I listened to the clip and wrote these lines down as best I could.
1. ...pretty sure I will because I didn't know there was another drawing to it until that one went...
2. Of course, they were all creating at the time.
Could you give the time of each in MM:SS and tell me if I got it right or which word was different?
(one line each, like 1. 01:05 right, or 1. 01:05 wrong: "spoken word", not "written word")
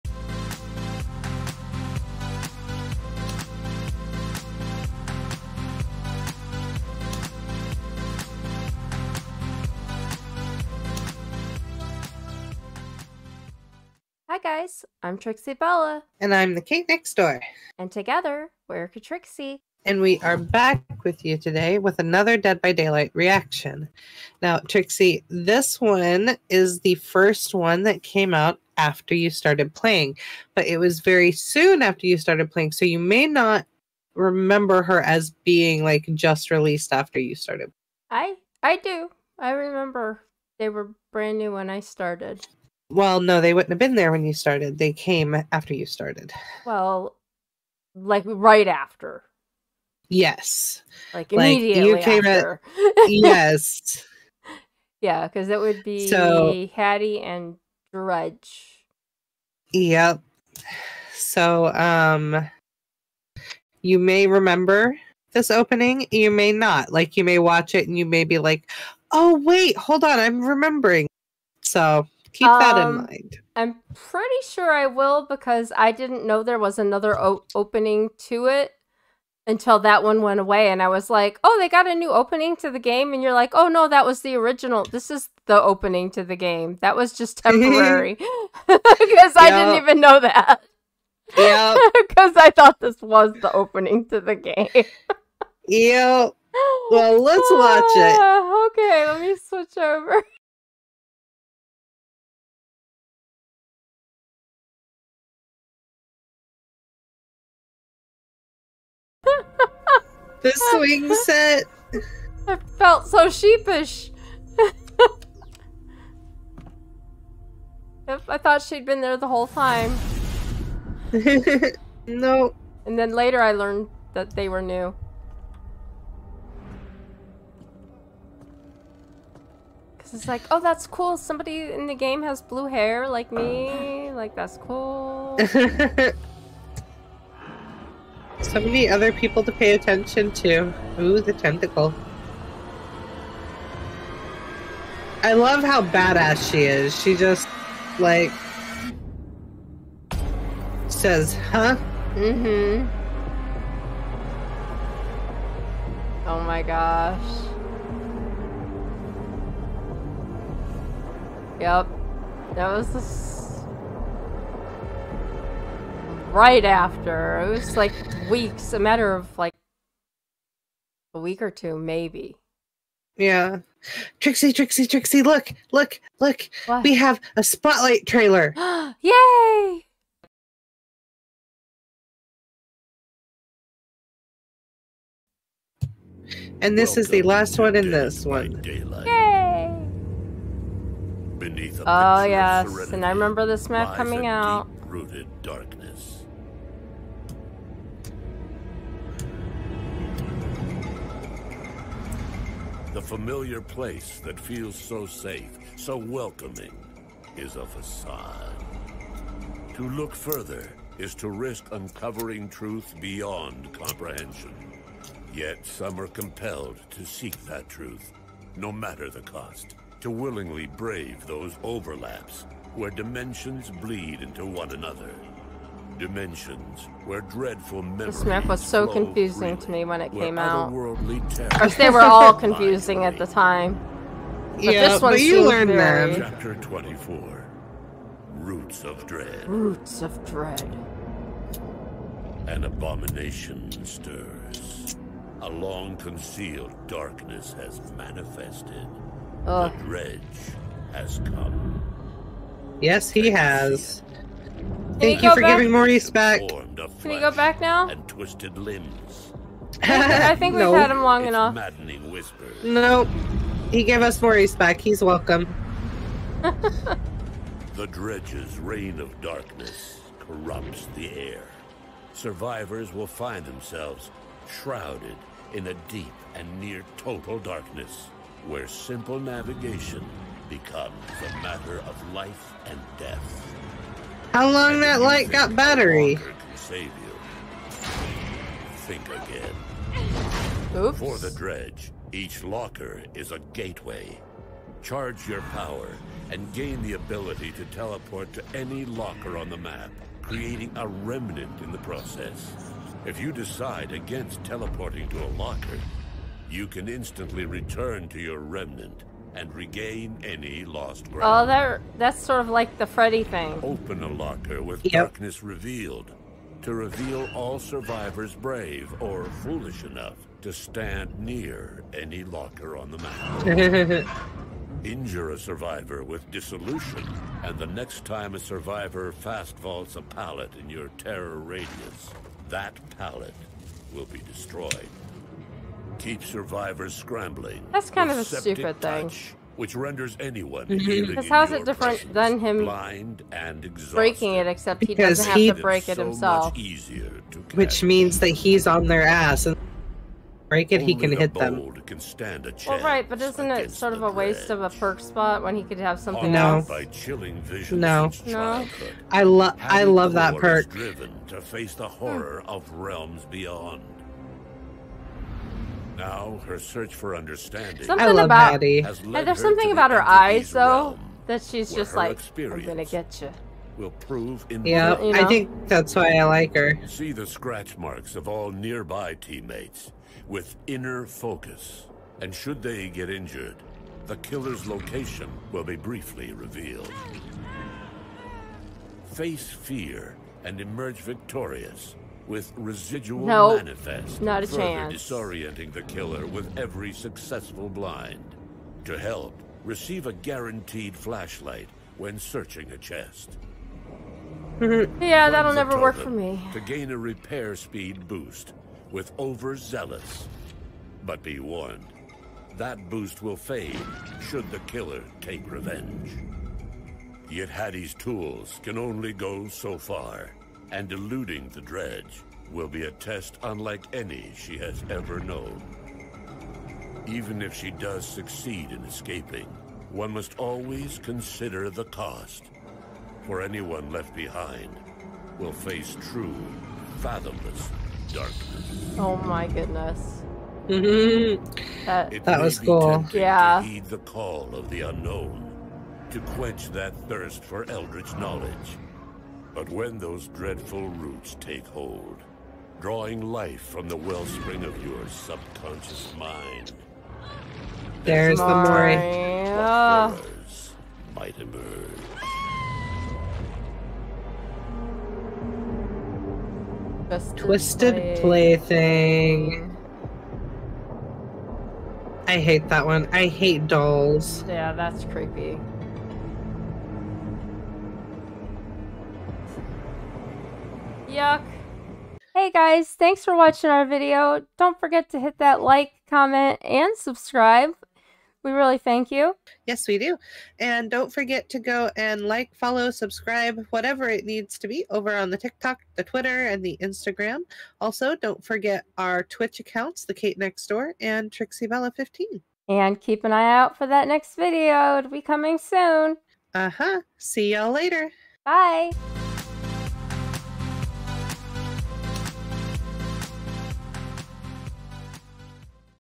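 1. 01:13 wrong: "opening", not "drawing"
2. 03:50 wrong: "confusing", not "creating".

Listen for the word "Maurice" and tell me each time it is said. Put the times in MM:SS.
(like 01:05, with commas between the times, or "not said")
04:15, 04:24.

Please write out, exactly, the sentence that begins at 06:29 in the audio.
Face fear and emerge victorious with residual nope.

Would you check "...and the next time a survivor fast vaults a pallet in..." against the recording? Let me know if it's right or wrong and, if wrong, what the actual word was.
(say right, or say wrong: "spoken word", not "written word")
right.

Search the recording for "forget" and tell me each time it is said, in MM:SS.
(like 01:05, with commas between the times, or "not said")
08:04, 08:11, 08:18.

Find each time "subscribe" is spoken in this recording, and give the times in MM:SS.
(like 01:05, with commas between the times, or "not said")
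08:06, 08:12.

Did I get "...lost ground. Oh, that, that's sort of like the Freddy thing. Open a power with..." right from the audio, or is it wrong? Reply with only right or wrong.
wrong.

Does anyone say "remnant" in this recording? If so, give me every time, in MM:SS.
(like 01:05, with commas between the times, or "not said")
05:00, 05:08.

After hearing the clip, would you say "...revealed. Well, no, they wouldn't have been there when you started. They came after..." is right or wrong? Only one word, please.
wrong.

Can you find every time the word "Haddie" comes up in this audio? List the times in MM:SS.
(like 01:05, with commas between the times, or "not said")
00:56, 06:57.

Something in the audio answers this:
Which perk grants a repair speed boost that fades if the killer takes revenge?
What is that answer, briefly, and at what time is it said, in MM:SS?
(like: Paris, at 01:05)
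Overzealous, at 06:49.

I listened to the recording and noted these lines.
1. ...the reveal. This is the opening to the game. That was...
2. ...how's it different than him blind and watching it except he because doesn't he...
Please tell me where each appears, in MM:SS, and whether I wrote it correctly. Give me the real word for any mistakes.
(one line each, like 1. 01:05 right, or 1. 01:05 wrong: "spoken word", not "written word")
1. 01:24 wrong: "original", not "reveal"
2. 05:41 wrong: "breaking", not "watching".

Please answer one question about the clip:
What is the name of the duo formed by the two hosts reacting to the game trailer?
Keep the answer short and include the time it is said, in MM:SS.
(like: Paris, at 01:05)
Katrixie, at 00:18.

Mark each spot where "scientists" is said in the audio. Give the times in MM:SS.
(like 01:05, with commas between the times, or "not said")
not said.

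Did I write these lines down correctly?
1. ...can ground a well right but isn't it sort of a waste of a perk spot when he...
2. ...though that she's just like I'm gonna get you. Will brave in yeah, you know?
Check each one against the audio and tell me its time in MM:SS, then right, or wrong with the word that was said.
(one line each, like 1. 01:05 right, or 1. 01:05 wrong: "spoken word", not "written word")
1. 05:51 wrong: "stand", not "ground"
2. 06:10 wrong: "prove", not "brave".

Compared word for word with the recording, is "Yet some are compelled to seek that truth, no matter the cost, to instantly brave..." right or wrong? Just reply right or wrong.
wrong.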